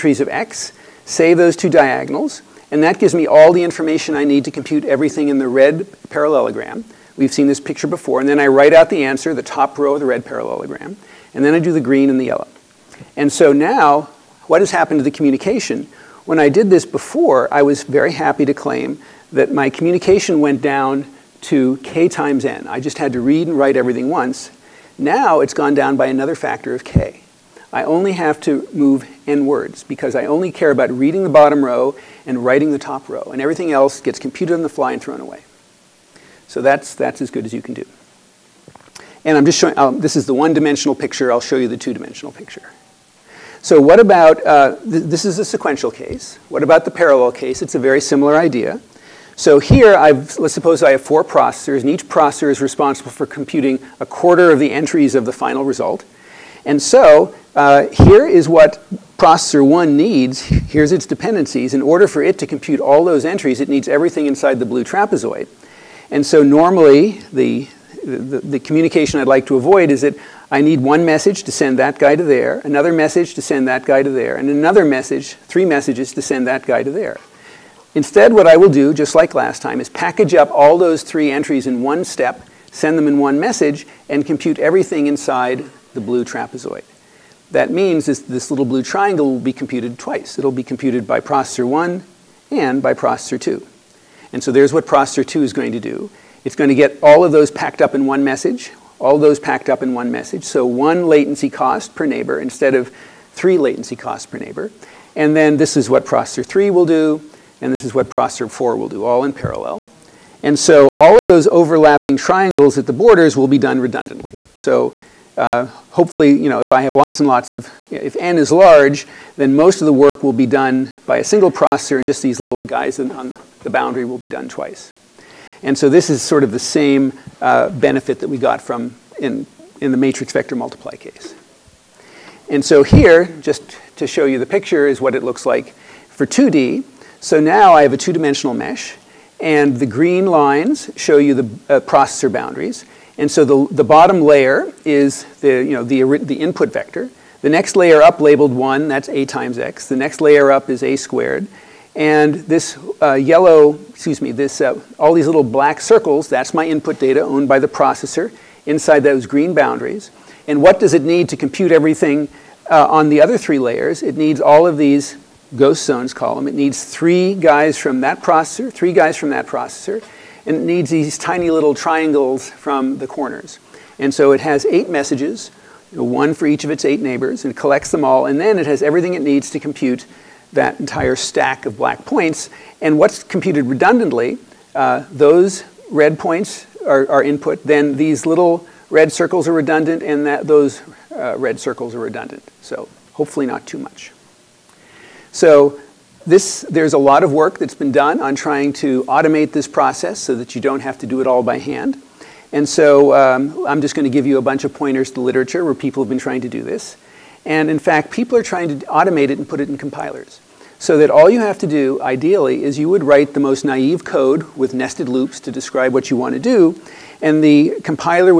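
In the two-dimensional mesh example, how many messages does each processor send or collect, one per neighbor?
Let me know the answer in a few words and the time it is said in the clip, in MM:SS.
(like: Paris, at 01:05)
8, at 02:54.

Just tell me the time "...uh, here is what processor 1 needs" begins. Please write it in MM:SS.
00:57.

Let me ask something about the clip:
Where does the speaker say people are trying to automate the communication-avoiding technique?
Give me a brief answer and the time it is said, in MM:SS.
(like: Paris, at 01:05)
compilers, at 03:29.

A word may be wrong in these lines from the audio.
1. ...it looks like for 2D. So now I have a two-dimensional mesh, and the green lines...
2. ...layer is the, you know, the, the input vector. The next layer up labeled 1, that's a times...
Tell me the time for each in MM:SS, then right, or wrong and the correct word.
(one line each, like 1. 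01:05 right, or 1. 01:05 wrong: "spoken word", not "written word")
1. 02:15 right
2. 02:24 right.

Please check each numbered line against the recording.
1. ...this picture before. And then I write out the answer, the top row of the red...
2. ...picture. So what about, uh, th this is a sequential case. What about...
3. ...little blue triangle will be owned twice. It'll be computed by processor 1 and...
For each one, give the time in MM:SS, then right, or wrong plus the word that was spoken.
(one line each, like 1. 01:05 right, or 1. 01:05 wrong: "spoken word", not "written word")
1. 00:07 right
2. 00:42 right
3. 01:28 wrong: "computed", not "owned".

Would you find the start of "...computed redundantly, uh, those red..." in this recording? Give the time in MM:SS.
03:03.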